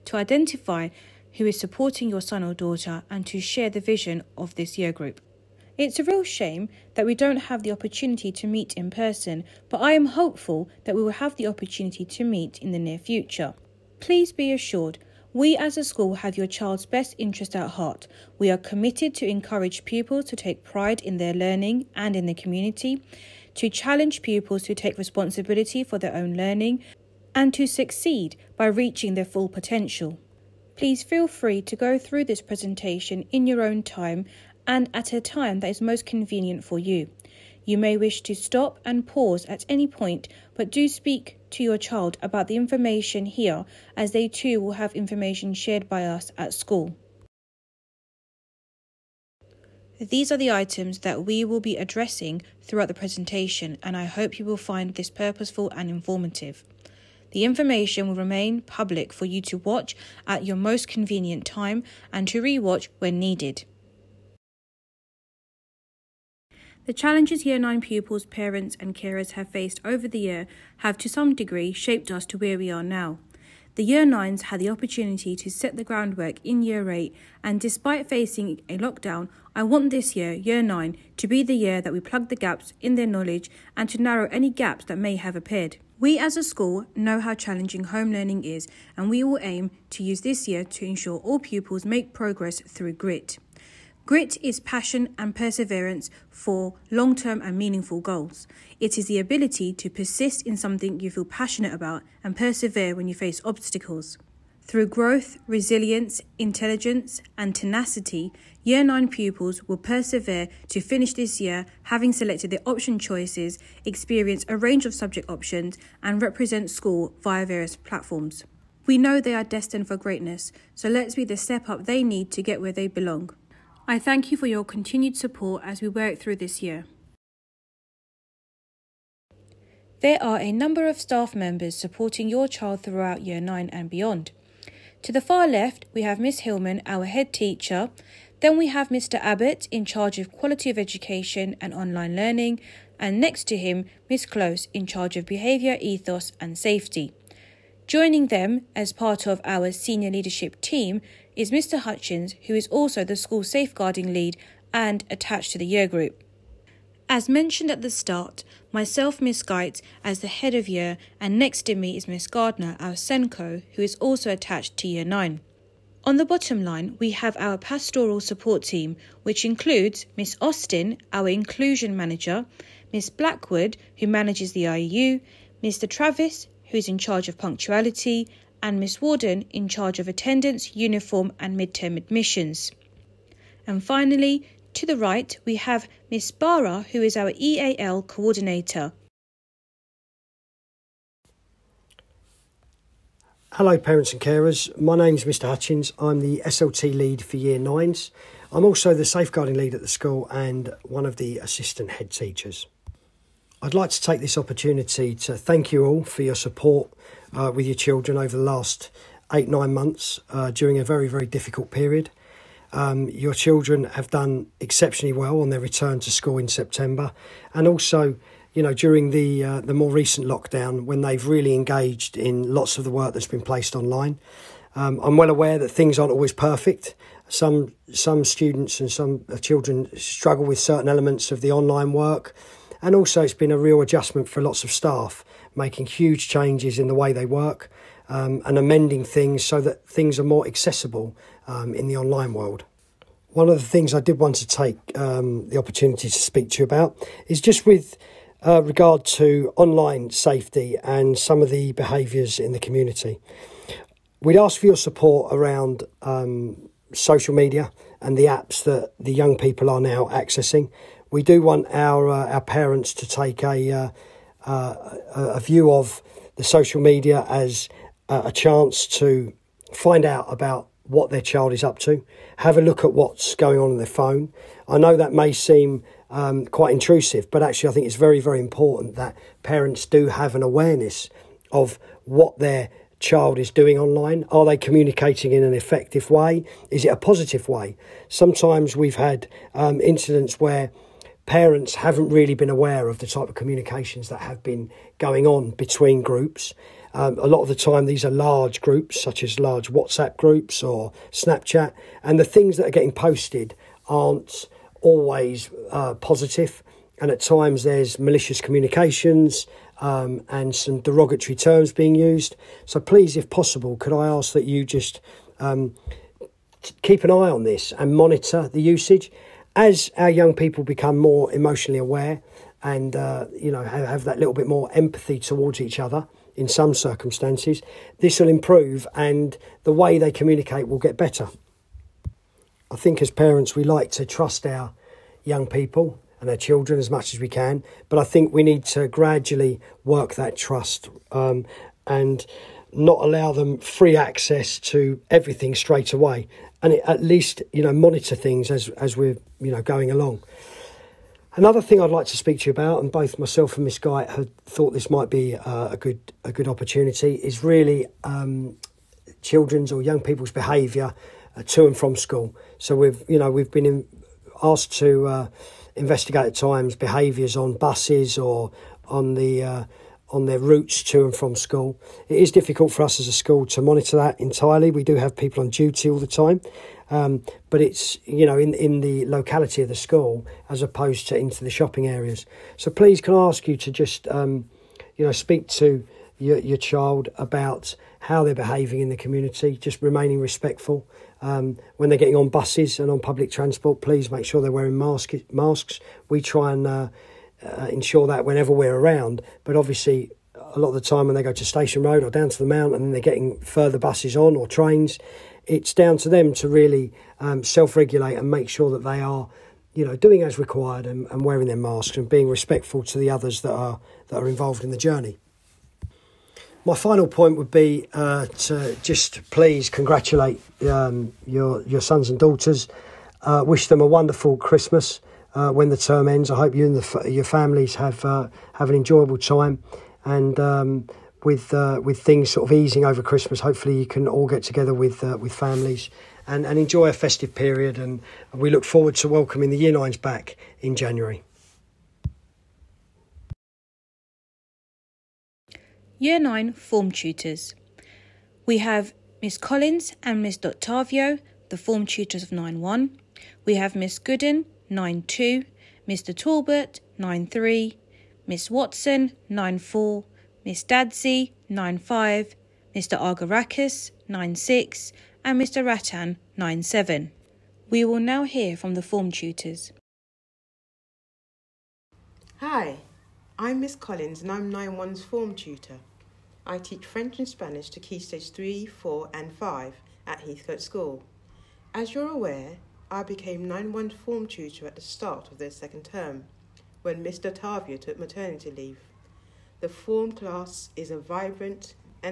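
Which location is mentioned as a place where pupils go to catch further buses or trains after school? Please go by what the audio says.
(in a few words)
Station Road.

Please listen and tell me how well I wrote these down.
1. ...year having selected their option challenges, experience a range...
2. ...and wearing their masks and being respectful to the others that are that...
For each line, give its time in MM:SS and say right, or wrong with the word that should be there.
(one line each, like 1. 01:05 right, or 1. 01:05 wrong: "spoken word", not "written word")
1. 01:51 wrong: "choices", not "challenges"
2. 06:51 right.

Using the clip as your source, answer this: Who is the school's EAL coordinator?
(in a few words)
Miss Barra.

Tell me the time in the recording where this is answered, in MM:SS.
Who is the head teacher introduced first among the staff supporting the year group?
02:16.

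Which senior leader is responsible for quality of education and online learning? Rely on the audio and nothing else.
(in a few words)
Mr. Abbott.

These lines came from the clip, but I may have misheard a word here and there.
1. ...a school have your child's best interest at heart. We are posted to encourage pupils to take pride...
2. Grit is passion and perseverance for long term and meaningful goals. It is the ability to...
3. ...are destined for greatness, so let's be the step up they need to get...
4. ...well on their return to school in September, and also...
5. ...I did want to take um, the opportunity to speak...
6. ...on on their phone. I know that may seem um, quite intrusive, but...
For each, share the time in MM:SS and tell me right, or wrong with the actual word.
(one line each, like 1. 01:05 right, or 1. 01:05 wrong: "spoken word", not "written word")
1. 00:15 wrong: "committed", not "posted"
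2. 01:34 right
3. 01:59 right
4. 03:35 right
5. 04:03 right
6. 04:33 right.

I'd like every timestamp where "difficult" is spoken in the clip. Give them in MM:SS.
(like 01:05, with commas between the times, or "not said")
03:31, 06:12.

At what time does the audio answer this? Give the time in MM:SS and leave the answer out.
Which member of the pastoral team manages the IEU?
02:52.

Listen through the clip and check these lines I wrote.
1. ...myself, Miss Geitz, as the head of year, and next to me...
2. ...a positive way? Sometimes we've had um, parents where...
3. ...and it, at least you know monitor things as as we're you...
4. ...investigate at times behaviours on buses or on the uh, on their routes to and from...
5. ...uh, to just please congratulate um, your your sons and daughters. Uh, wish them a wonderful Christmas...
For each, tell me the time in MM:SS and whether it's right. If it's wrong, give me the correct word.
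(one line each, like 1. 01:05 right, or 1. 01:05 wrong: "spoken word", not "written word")
1. 02:38 right
2. 04:46 wrong: "incidents", not "parents"
3. 05:46 right
4. 06:05 right
5. 06:57 right.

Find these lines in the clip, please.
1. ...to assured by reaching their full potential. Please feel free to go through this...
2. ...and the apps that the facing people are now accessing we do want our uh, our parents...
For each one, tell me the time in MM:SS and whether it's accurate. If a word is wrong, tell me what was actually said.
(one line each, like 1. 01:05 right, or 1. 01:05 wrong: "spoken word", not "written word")
1. 00:27 wrong: "succeed", not "assured"
2. 04:18 wrong: "young", not "facing".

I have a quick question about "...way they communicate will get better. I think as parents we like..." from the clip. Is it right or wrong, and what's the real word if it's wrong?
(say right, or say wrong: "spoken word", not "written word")
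right.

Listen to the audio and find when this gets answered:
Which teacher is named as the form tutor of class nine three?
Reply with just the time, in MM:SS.
07:35.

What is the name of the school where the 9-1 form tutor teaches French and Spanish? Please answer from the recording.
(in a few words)
Heathcote School.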